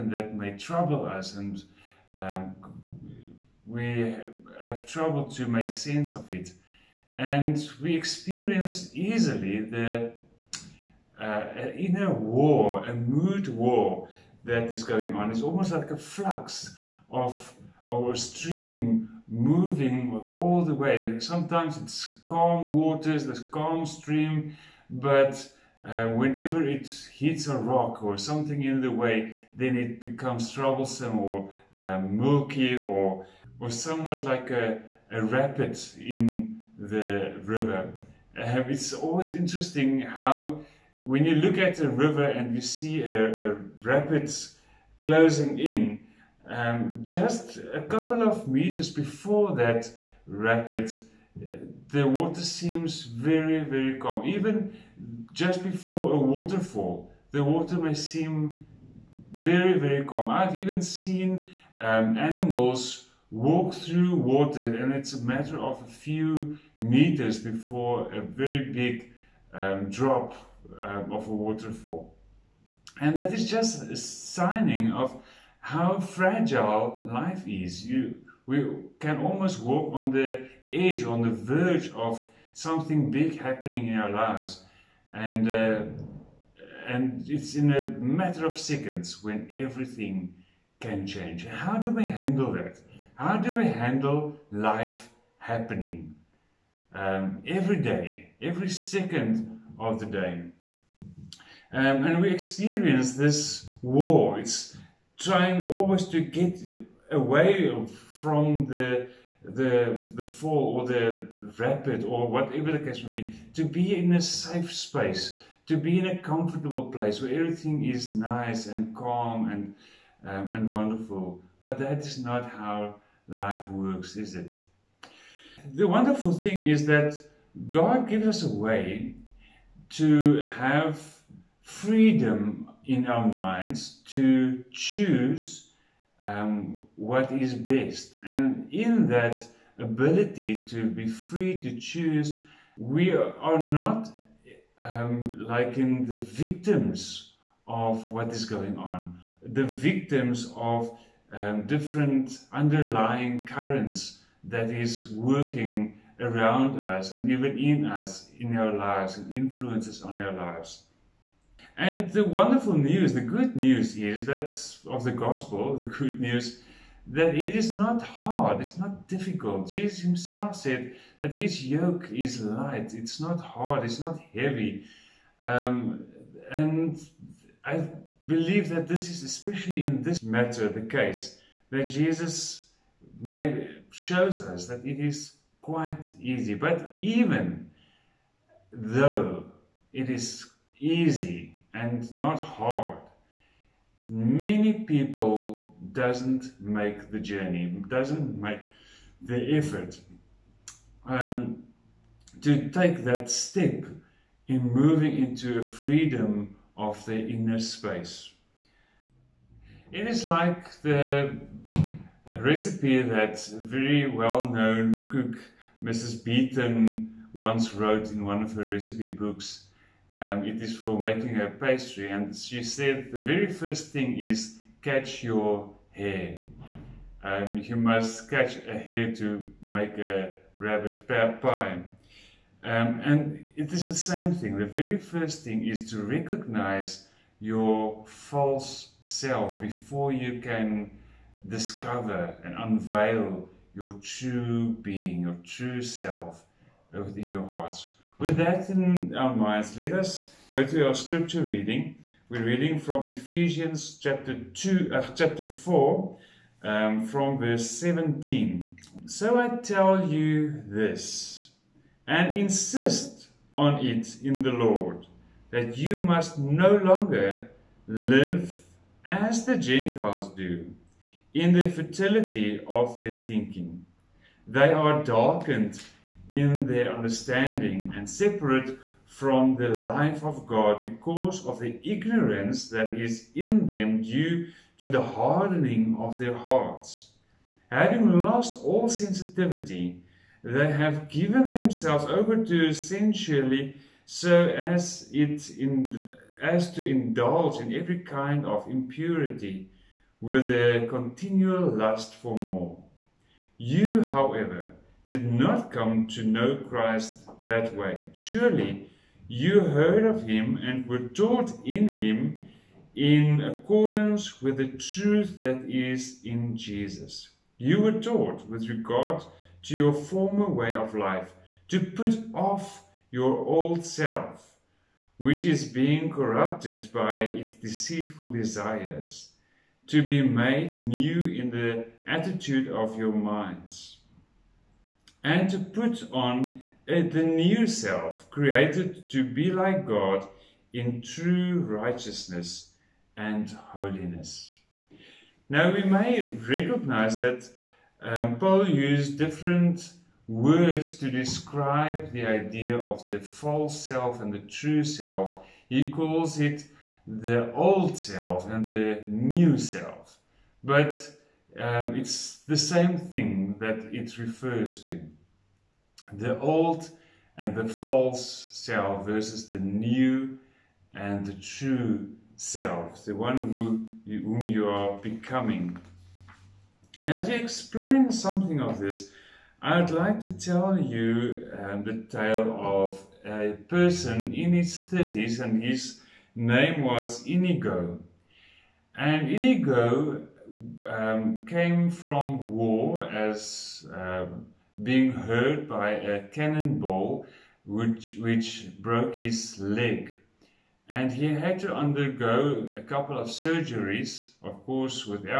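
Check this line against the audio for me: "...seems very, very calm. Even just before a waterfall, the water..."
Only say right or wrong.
right.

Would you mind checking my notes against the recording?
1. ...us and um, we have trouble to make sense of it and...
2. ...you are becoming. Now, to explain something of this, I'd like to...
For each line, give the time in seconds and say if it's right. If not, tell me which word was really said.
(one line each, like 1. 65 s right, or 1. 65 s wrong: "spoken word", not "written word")
1. 1 s right
2. 374 s right.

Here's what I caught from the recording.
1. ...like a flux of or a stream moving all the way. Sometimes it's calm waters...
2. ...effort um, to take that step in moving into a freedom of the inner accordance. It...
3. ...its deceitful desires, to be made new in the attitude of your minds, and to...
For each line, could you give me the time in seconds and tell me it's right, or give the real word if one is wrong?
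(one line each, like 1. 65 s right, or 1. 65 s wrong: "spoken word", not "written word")
1. 15 s right
2. 199 s wrong: "space", not "accordance"
3. 327 s right.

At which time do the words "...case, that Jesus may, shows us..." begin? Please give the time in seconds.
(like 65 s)
180 s.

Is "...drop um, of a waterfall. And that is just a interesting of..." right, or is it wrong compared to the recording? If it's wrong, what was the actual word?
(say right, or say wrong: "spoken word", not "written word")
wrong: "signing", not "interesting".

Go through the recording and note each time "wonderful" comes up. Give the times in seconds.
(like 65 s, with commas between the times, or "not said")
120 s, 125 s, 162 s.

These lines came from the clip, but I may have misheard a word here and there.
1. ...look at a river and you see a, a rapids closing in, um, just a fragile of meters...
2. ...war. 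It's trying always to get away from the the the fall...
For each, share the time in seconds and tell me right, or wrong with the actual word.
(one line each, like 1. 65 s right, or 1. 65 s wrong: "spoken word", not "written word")
1. 41 s wrong: "couple", not "fragile"
2. 103 s right.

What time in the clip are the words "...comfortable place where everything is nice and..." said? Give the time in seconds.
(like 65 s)
116 s.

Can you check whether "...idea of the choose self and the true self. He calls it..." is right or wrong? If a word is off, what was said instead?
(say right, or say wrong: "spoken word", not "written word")
wrong: "false", not "choose".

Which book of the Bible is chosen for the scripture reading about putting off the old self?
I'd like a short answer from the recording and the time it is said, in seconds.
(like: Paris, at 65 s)
Ephesians, at 253 s.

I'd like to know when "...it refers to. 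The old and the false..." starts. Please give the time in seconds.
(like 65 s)
363 s.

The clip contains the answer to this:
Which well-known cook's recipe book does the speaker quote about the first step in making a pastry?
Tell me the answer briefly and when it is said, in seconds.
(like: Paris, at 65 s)
Mrs. Beaton, at 215 s.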